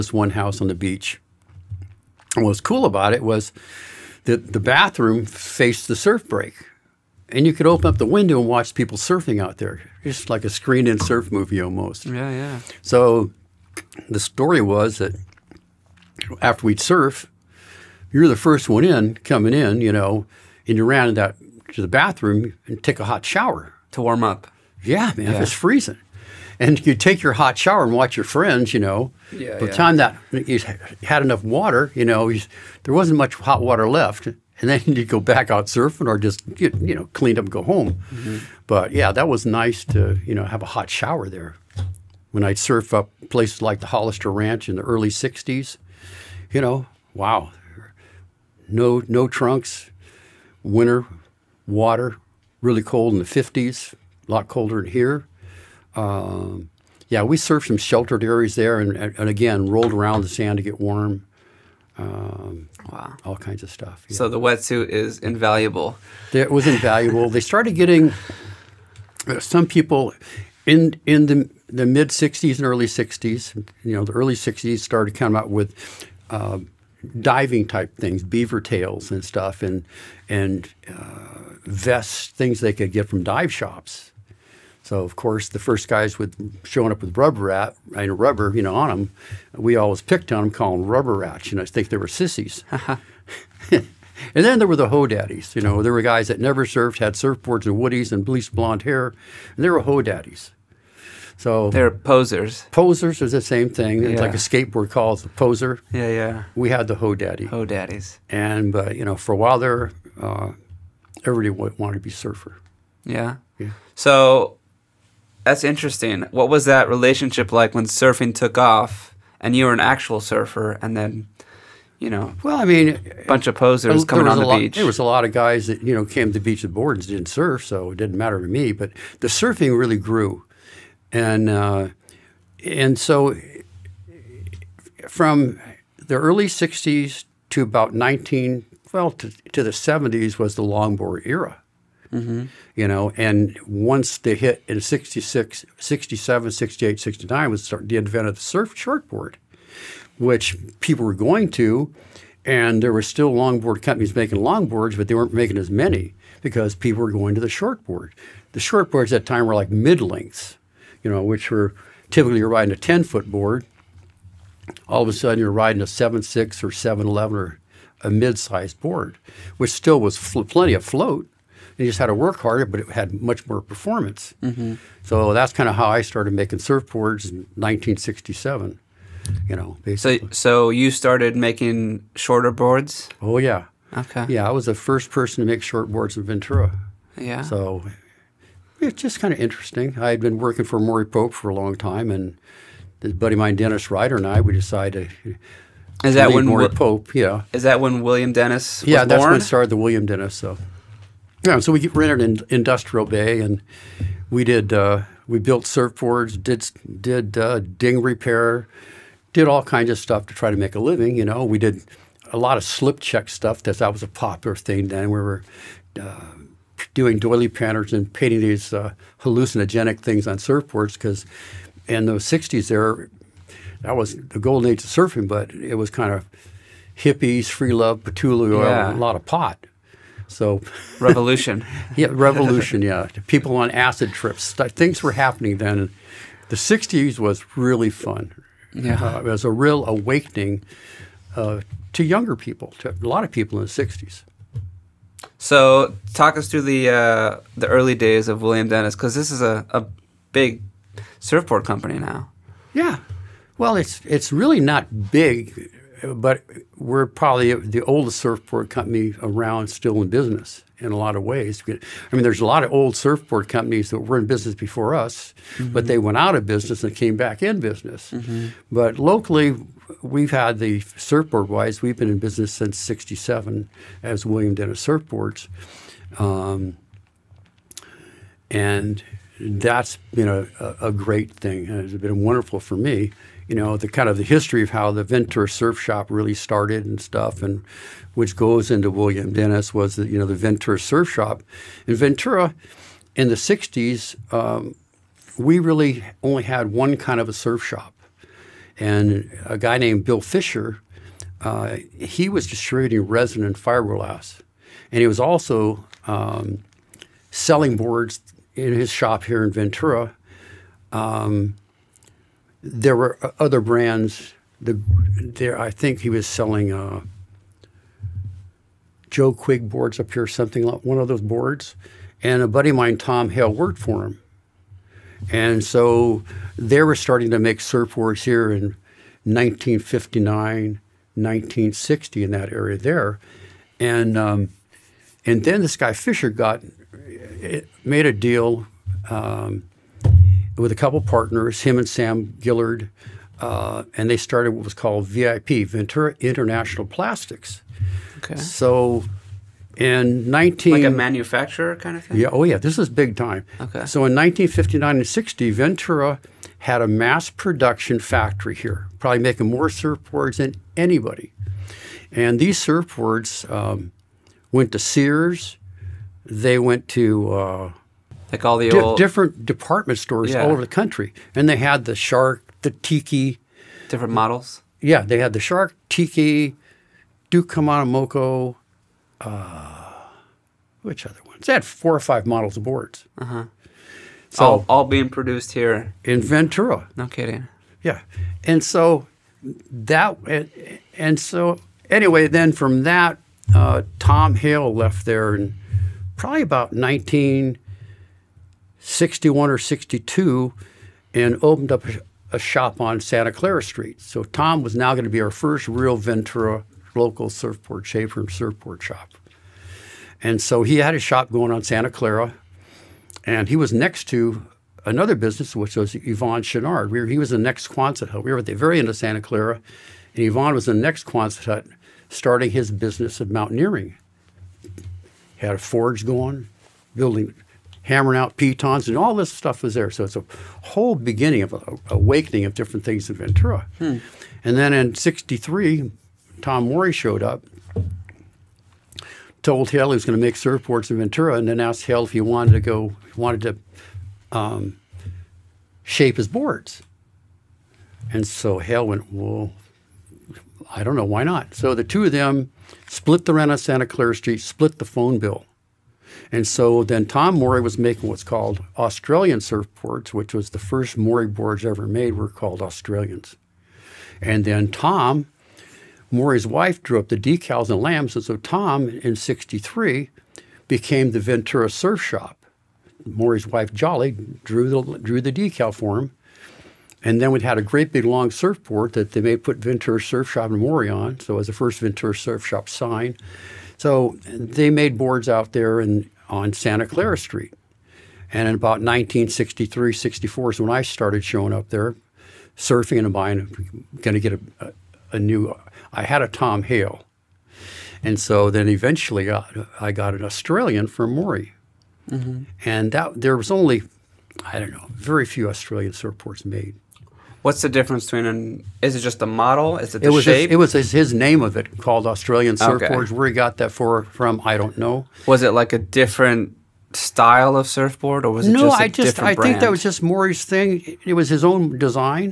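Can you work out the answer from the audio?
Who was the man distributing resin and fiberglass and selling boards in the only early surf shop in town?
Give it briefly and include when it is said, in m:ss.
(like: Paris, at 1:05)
Bill Fisher, at 5:00.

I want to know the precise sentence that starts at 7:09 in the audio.
So it's a whole beginning of a, awakening of different things in Ventura.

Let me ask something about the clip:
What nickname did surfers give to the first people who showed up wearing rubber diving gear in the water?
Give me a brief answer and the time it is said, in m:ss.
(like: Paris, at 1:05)
Rubber rats, at 1:30.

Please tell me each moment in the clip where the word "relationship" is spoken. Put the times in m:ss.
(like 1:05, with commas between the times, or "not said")
1:56.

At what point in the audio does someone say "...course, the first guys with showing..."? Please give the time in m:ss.
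1:25.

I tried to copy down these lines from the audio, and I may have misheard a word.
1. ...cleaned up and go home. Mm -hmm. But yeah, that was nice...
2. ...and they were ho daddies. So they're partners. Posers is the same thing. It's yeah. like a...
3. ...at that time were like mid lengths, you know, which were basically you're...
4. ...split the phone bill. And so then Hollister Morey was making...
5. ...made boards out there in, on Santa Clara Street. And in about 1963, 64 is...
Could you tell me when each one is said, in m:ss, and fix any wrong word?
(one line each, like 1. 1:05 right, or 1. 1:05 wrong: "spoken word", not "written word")
1. 0:37 right
2. 1:39 wrong: "posers", not "partners"
3. 2:39 wrong: "typically", not "basically"
4. 7:34 wrong: "Tom", not "Hollister"
5. 8:04 right.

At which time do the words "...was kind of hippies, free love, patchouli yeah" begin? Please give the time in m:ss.
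3:45.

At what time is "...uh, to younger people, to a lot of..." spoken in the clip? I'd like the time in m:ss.
4:01.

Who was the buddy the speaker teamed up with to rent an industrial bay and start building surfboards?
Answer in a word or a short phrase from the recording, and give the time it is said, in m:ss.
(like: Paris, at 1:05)
Dennis Ryder, at 3:13.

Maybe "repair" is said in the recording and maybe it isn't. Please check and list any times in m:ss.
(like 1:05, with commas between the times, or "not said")
3:28.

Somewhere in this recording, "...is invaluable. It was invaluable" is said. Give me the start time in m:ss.
1:04.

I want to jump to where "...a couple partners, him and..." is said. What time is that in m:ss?
5:40.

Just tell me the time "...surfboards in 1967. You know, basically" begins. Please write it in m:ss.
2:56.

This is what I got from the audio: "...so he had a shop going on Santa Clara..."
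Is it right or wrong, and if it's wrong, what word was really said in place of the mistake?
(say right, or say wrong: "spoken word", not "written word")
right.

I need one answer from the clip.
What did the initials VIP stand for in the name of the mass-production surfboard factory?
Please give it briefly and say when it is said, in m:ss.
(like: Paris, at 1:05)
Ventura International Plastics, at 5:45.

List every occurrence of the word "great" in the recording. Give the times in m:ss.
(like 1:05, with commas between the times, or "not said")
4:41, 7:57.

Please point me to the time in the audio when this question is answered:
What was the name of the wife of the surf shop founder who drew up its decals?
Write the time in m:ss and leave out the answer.
7:53.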